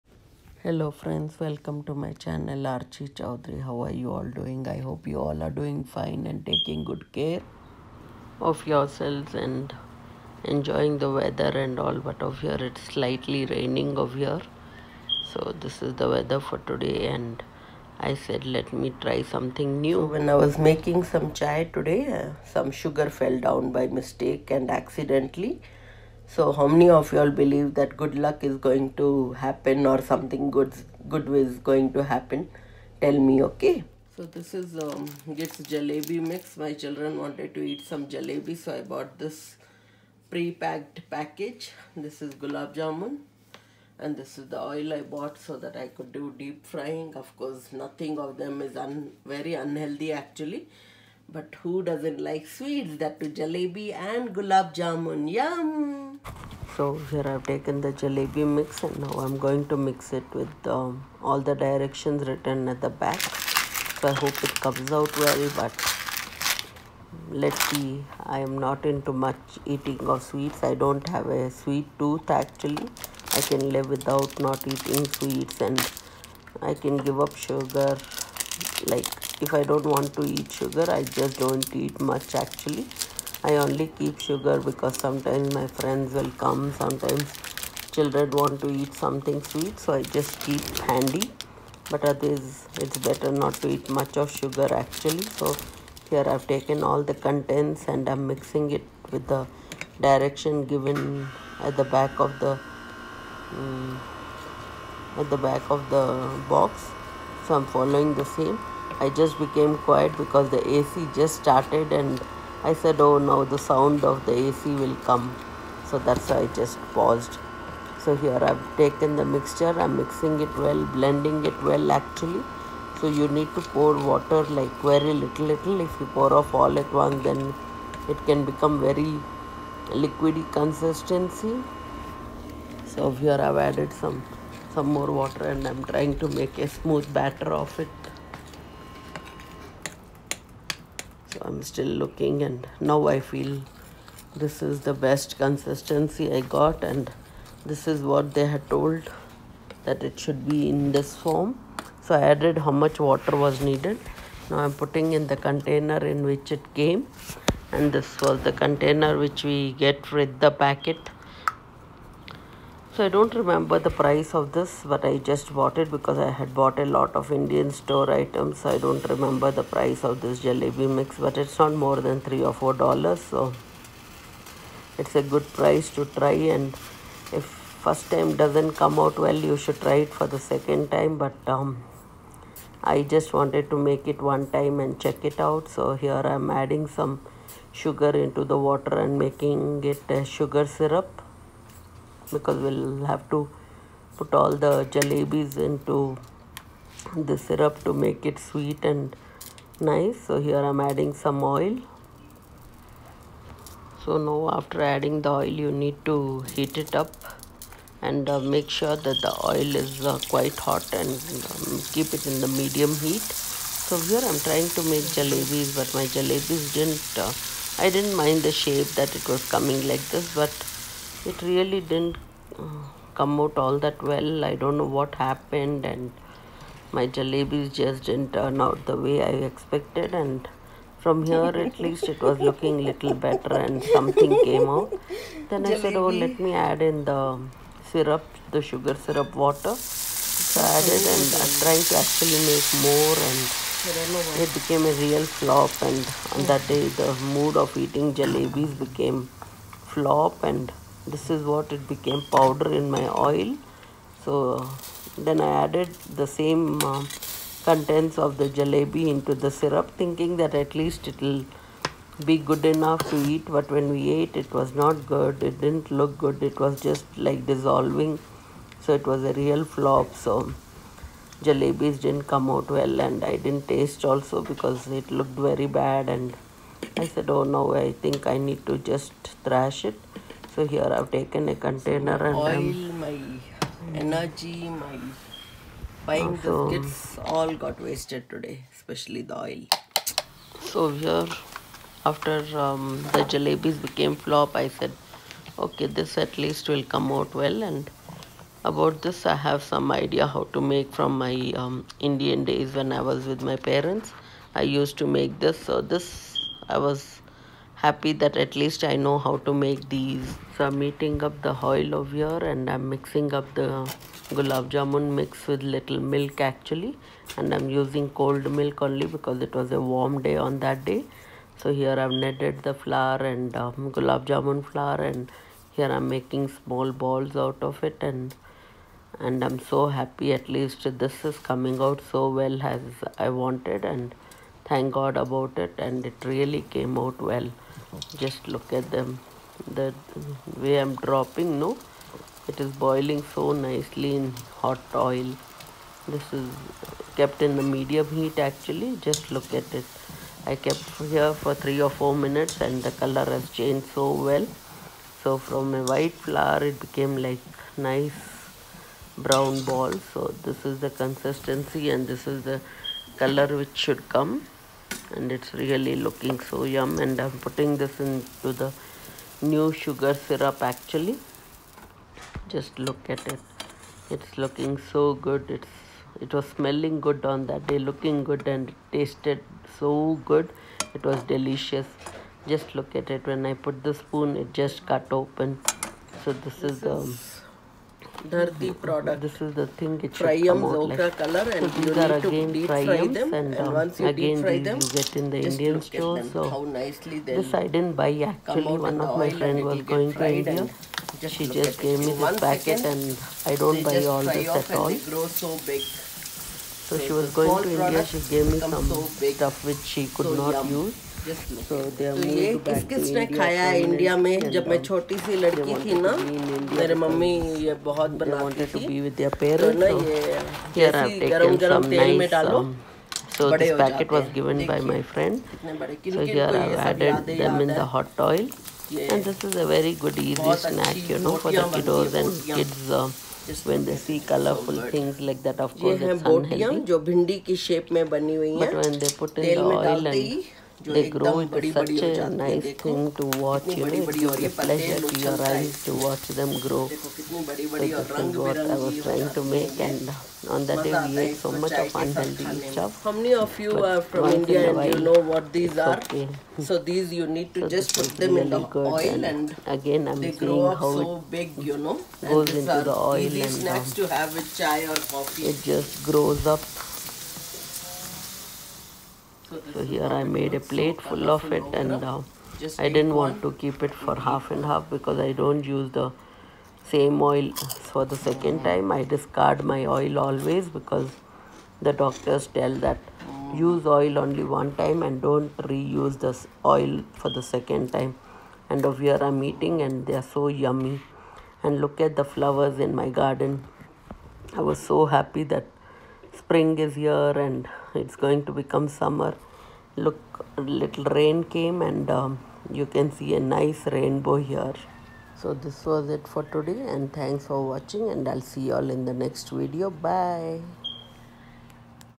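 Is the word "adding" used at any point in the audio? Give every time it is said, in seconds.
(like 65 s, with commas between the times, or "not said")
186 s, 200 s, 204 s.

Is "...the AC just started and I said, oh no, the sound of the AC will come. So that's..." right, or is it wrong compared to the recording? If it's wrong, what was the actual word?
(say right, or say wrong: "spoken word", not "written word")
right.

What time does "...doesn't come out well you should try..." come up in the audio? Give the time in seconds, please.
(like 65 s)
178 s.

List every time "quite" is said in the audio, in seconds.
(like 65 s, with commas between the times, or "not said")
210 s.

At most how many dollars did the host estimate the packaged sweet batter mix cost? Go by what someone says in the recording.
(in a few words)
3 or 4 dollars.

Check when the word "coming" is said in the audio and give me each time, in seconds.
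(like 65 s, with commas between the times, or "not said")
219 s, 331 s.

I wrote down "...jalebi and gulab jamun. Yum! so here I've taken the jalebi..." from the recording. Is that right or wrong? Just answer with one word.
right.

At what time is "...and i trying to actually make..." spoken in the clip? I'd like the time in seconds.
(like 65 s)
241 s.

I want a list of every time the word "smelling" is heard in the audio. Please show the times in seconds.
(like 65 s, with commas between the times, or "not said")
376 s.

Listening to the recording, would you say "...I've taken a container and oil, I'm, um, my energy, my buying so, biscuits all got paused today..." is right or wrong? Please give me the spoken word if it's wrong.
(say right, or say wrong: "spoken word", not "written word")
wrong: "wasted", not "paused".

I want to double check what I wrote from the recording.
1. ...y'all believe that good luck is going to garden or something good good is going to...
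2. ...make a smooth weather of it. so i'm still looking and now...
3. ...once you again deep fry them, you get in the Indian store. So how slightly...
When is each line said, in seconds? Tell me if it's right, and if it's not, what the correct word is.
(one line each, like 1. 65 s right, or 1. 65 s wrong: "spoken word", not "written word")
1. 27 s wrong: "happen", not "garden"
2. 136 s wrong: "batter", not "weather"
3. 393 s wrong: "nicely", not "slightly".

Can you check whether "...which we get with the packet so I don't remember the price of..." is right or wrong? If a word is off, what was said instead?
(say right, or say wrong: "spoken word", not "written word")
right.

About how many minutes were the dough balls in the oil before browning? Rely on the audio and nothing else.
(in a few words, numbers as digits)
3 or 4 minutes.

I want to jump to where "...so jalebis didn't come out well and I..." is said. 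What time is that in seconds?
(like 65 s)
270 s.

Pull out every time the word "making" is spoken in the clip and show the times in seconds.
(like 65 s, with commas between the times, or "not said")
20 s, 189 s, 326 s.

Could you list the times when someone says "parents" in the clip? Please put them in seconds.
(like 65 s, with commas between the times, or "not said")
303 s.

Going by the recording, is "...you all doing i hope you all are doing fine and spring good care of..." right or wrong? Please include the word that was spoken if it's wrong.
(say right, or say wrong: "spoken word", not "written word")
wrong: "taking", not "spring".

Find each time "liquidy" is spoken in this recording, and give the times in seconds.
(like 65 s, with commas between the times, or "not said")
129 s.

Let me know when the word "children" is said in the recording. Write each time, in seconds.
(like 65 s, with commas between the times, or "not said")
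36 s, 87 s.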